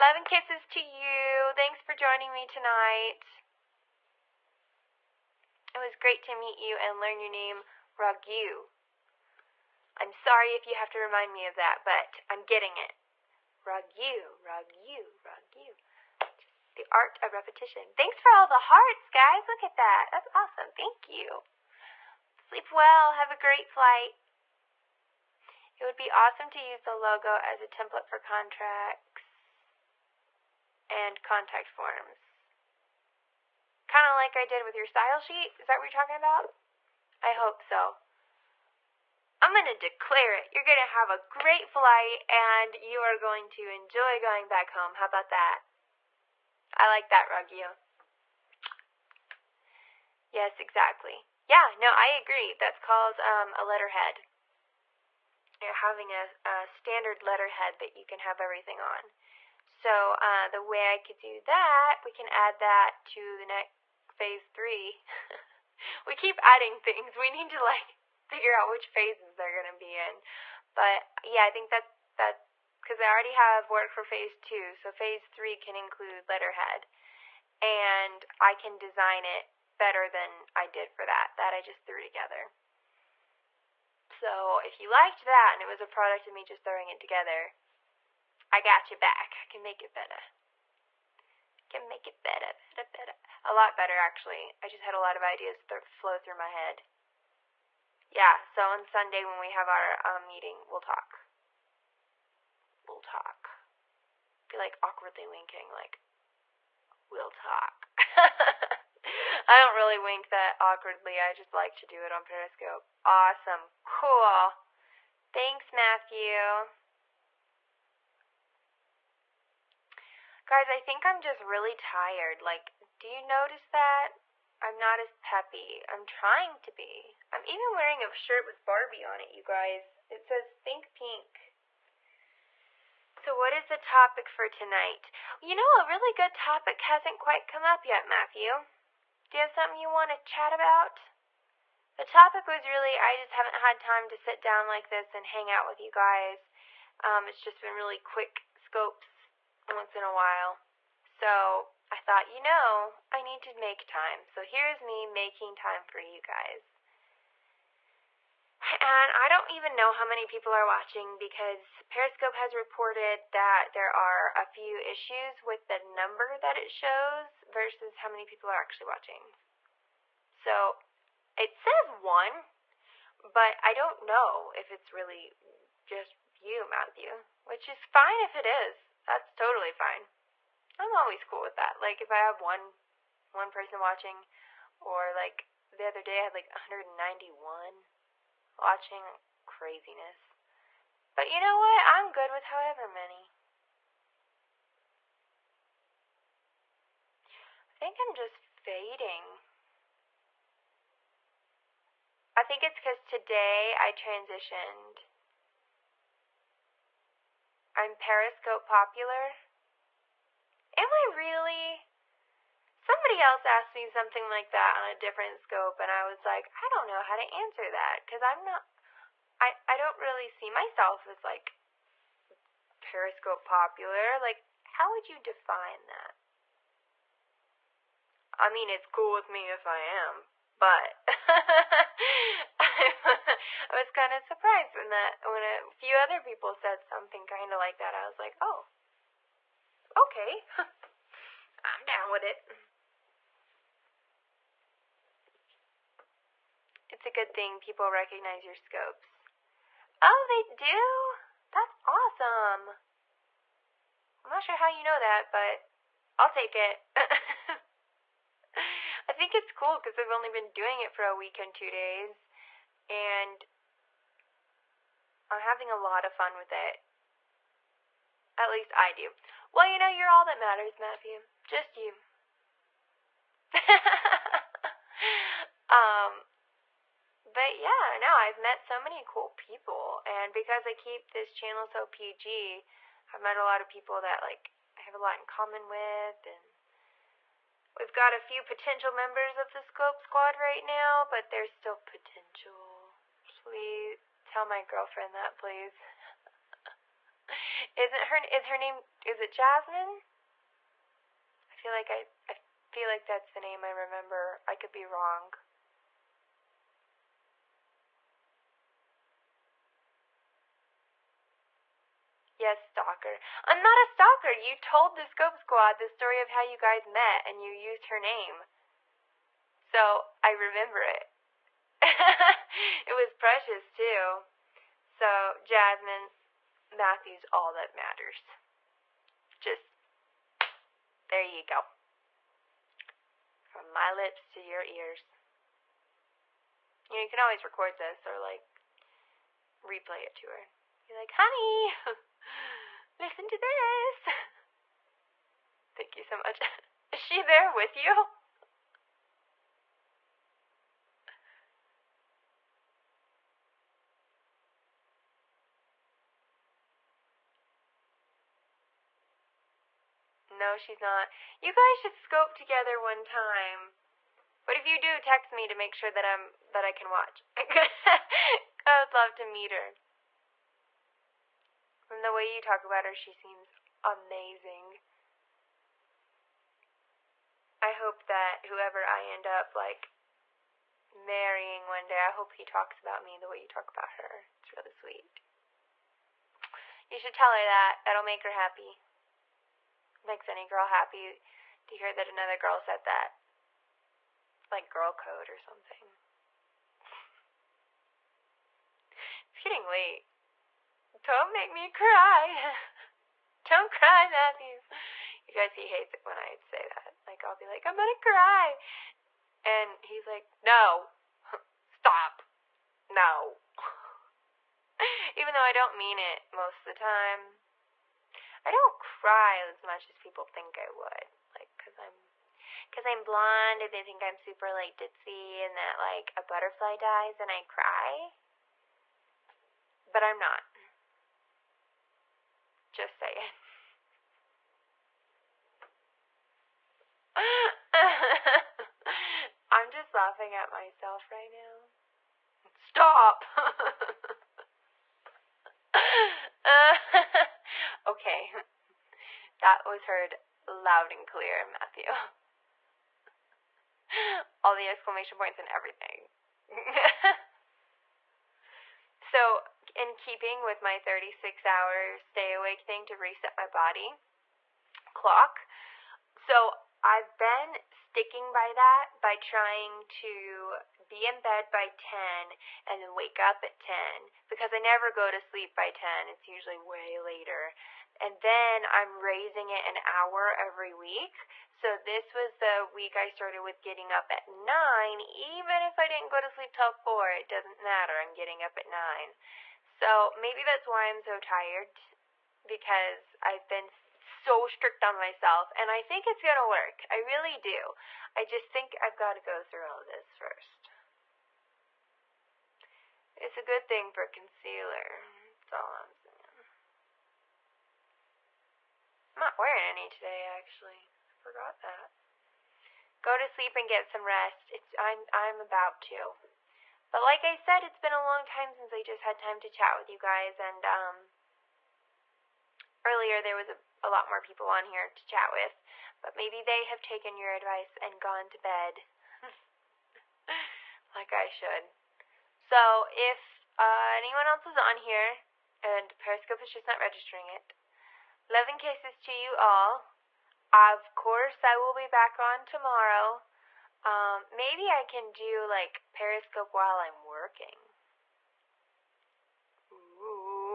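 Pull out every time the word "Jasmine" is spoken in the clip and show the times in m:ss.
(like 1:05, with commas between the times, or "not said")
4:59, 5:25.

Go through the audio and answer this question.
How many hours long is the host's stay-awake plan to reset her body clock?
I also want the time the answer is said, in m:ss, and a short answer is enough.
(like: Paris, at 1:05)
36, at 7:40.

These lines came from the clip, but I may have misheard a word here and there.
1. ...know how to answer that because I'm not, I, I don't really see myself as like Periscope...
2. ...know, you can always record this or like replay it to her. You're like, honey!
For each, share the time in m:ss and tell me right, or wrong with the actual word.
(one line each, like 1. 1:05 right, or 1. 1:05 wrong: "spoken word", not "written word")
1. 3:36 right
2. 5:36 right.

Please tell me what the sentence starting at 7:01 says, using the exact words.
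Like, cause I'm, cause I'm blonde and they think I'm super like ditzy and that like a butterfly dies and I cry.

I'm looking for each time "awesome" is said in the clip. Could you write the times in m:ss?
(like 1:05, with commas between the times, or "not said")
0:20, 0:26, 1:53, 4:11.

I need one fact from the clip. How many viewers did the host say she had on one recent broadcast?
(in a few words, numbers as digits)
191.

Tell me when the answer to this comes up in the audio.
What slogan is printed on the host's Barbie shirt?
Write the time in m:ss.
2:10.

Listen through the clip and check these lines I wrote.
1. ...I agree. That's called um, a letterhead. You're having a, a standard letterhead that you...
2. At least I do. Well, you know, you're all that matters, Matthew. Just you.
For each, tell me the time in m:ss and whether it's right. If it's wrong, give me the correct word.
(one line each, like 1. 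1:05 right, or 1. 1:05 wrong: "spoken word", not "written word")
1. 0:51 right
2. 4:28 right.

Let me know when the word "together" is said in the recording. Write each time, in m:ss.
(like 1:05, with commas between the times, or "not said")
1:22, 1:26, 6:02.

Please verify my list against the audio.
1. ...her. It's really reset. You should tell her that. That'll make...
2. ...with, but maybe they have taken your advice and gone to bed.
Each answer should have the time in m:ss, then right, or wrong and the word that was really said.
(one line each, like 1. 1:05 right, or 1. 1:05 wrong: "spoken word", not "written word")
1. 6:23 wrong: "sweet", not "reset"
2. 8:45 right.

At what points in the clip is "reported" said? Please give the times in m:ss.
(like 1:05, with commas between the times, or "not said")
2:42.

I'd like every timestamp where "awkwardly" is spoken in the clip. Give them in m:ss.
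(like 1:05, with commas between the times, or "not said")
1:44, 1:50.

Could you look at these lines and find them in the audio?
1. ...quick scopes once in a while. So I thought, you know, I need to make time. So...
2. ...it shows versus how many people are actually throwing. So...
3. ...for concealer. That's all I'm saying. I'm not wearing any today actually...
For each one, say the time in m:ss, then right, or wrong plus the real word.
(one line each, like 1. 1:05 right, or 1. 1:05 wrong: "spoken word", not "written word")
1. 2:27 right
2. 2:46 wrong: "watching", not "throwing"
3. 8:23 right.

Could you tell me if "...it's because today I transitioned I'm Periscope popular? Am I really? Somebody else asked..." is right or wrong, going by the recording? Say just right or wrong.
right.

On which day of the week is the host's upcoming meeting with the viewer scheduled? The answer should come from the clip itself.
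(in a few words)
Sunday.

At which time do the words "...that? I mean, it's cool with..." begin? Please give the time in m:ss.
3:45.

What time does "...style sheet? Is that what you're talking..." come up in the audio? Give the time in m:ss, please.
0:34.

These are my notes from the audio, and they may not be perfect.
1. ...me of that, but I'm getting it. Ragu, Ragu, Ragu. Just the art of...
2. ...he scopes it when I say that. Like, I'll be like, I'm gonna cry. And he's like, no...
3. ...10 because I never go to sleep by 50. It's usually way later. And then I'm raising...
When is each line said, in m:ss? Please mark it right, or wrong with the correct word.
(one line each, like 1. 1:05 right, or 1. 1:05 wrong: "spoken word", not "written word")
1. 0:11 right
2. 6:45 wrong: "hates", not "scopes"
3. 7:53 wrong: "10", not "50".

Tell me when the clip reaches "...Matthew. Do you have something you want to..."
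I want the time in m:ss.
2:18.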